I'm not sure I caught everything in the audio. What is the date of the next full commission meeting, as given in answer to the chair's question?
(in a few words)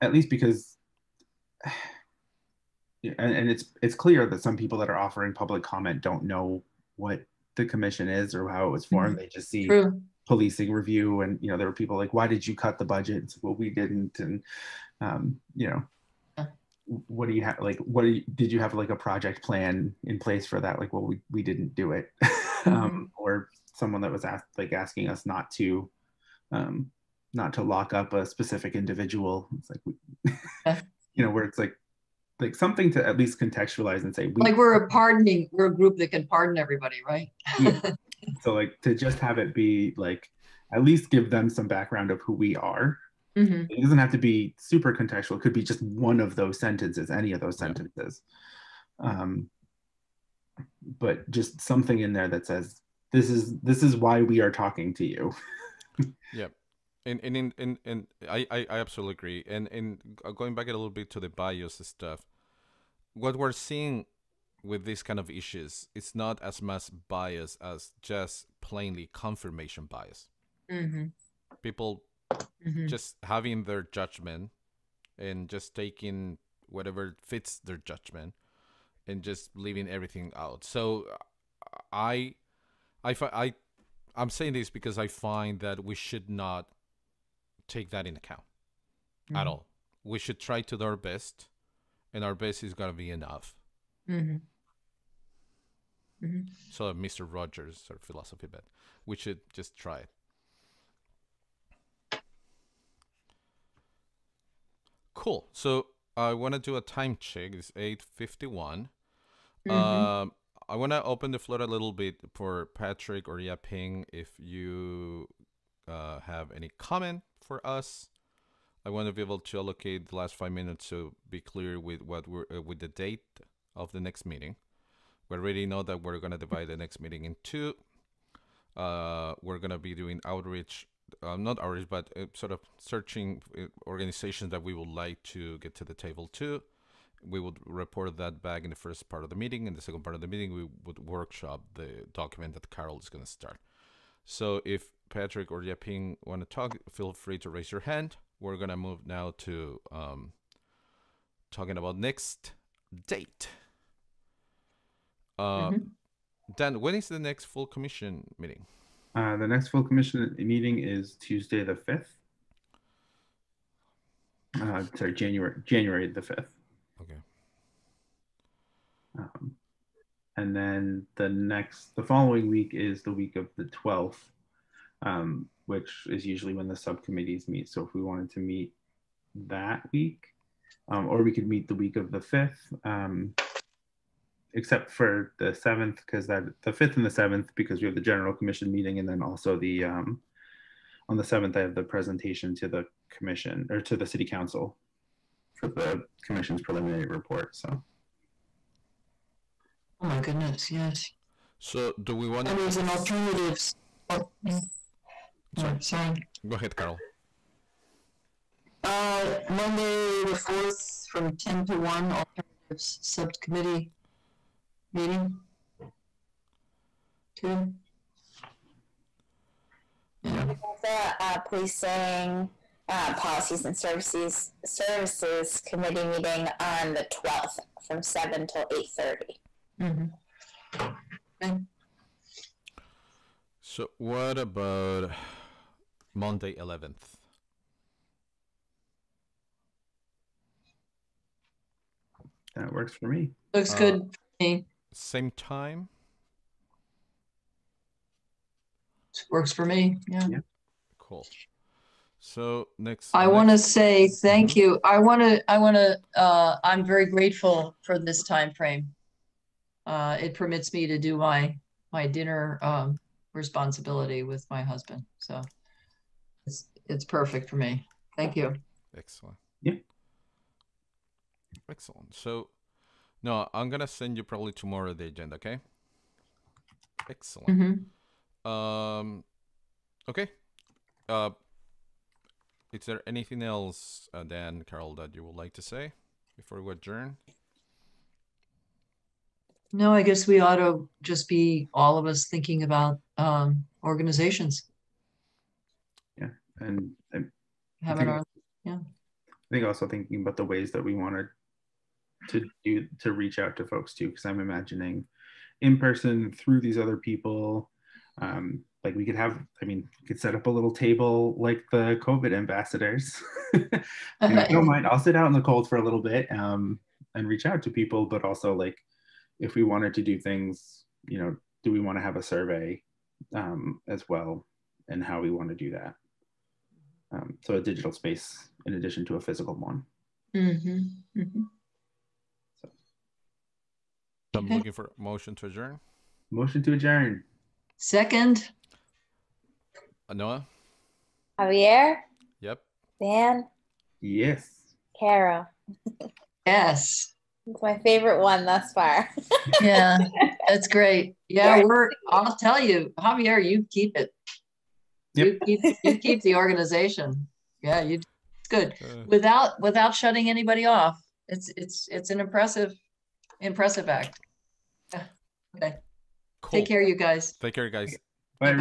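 January 5.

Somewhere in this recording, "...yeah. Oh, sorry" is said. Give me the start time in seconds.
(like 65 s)
204 s.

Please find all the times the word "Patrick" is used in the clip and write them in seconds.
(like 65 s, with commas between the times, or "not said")
112 s, 145 s.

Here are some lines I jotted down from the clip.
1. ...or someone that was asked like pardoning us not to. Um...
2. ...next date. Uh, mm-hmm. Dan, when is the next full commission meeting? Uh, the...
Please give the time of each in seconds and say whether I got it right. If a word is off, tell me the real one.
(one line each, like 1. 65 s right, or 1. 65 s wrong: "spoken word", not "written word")
1. 23 s wrong: "asking", not "pardoning"
2. 151 s right.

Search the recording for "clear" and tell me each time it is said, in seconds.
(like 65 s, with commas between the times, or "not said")
3 s, 121 s.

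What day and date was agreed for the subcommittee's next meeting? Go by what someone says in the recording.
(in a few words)
Monday 11th.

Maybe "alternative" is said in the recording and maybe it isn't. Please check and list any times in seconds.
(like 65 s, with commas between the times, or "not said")
202 s, 212 s.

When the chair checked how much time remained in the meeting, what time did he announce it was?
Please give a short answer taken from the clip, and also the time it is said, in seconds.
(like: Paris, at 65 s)
8:51, at 107 s.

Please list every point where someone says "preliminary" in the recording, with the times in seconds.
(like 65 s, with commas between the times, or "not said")
196 s.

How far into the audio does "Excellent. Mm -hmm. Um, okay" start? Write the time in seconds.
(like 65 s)
277 s.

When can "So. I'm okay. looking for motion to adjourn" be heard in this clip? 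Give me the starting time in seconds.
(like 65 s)
332 s.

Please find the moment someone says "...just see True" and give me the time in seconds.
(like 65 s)
9 s.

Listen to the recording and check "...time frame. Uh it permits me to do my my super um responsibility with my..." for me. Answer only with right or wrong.
wrong.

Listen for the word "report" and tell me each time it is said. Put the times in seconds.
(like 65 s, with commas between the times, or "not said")
137 s, 197 s.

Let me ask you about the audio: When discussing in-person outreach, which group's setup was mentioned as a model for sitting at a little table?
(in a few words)
COVID ambassadors.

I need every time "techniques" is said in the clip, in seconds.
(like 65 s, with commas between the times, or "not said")
not said.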